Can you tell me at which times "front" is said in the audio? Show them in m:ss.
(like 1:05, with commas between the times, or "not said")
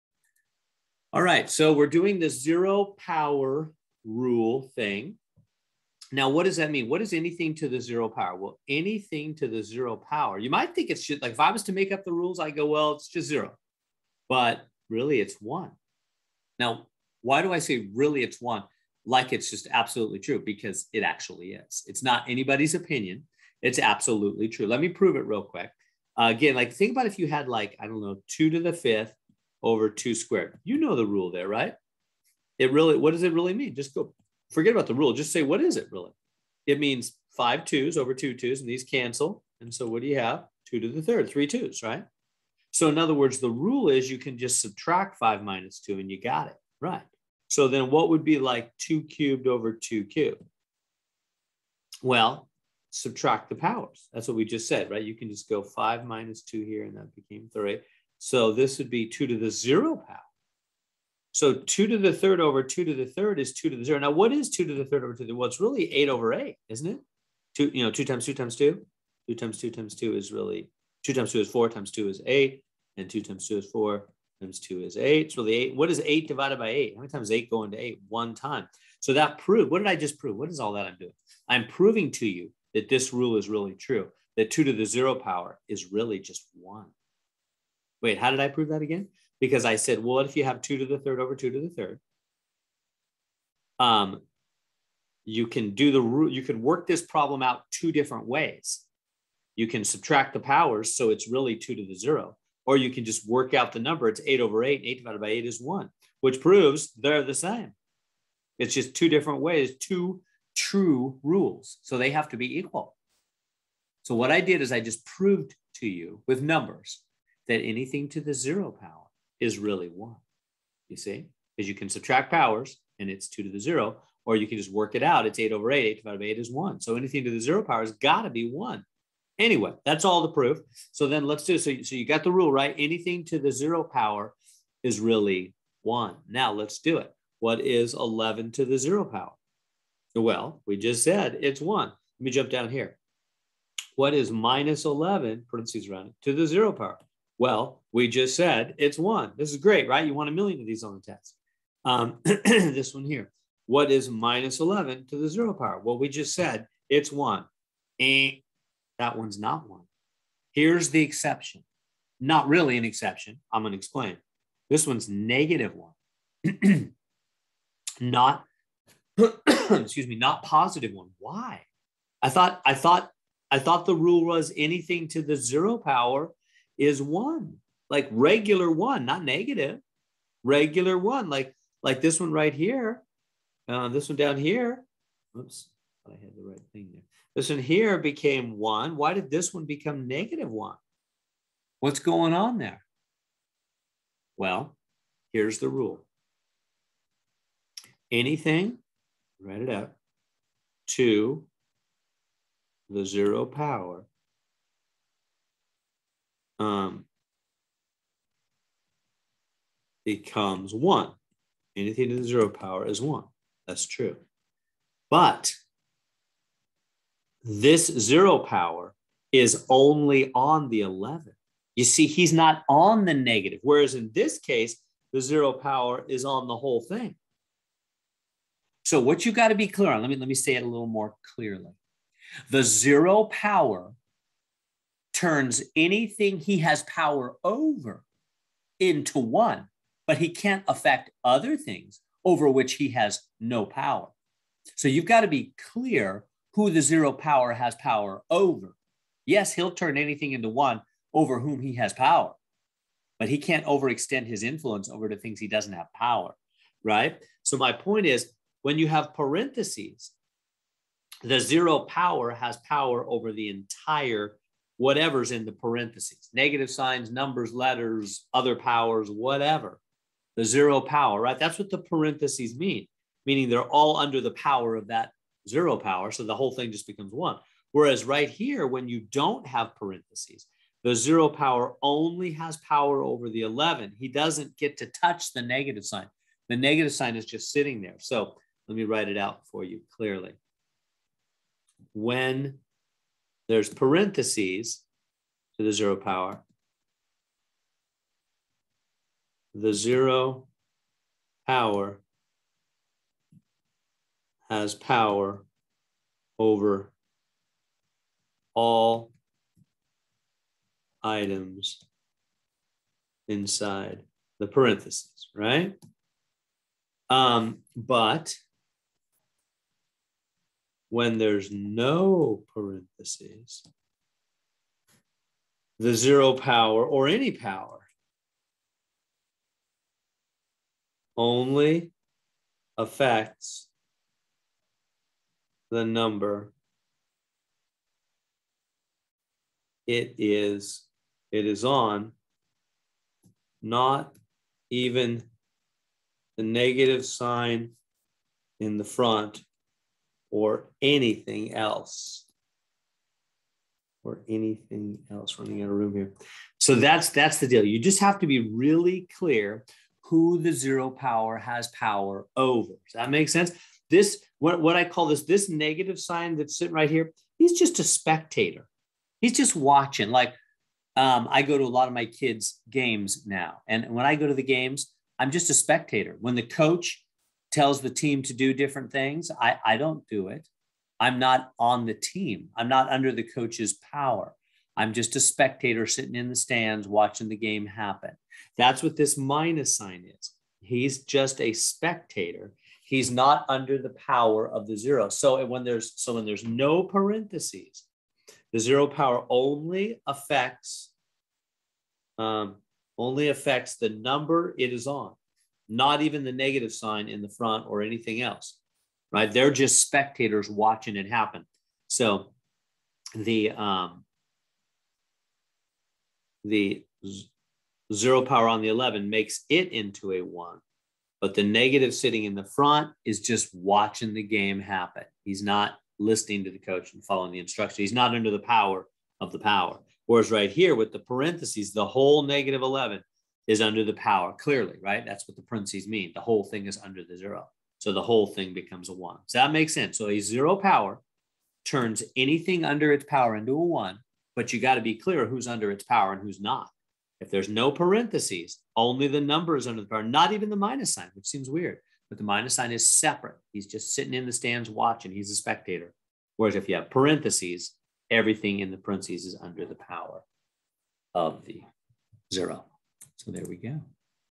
5:48, 6:47, 7:02.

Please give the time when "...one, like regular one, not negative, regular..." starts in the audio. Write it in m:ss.
2:56.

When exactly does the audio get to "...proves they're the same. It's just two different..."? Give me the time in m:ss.
1:46.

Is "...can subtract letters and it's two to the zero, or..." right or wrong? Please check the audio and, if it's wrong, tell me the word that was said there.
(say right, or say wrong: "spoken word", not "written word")
wrong: "powers", not "letters".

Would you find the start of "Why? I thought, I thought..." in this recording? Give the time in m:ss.
2:51.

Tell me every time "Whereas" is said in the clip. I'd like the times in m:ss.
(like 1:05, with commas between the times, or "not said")
3:43, 4:37, 7:10, 7:36.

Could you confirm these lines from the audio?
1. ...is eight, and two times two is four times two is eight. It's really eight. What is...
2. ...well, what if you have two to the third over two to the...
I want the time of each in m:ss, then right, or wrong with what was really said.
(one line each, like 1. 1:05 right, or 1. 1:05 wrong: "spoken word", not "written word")
1. 1:12 right
2. 1:29 right.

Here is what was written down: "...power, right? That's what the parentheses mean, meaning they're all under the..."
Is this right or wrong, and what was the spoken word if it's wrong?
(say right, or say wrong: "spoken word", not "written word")
right.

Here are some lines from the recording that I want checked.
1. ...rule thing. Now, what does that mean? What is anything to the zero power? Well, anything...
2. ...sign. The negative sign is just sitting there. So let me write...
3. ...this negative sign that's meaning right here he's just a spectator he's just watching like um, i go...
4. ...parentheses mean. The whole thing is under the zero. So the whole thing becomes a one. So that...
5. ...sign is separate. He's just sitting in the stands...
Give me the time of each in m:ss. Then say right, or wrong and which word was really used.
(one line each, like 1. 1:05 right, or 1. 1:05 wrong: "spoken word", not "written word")
1. 0:04 right
2. 4:45 right
3. 6:05 wrong: "sitting", not "meaning"
4. 7:15 right
5. 7:32 right.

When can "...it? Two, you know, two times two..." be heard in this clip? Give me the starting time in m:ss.
1:06.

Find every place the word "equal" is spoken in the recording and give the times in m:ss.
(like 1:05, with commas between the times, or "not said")
1:52.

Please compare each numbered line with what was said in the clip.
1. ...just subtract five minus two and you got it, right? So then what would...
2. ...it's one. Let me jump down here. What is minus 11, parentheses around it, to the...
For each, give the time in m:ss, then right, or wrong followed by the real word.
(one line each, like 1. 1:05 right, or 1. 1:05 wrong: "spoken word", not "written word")
1. 0:44 right
2. 2:21 right.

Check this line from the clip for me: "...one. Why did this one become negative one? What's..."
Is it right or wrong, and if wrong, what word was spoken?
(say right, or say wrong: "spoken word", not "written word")
right.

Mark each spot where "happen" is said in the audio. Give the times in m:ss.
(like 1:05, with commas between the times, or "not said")
6:27, 6:51, 7:04.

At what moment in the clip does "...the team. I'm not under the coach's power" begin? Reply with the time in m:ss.
6:21.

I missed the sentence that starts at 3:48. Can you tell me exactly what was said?
So what you have got to be clear on, let me let me say it a little more clearly.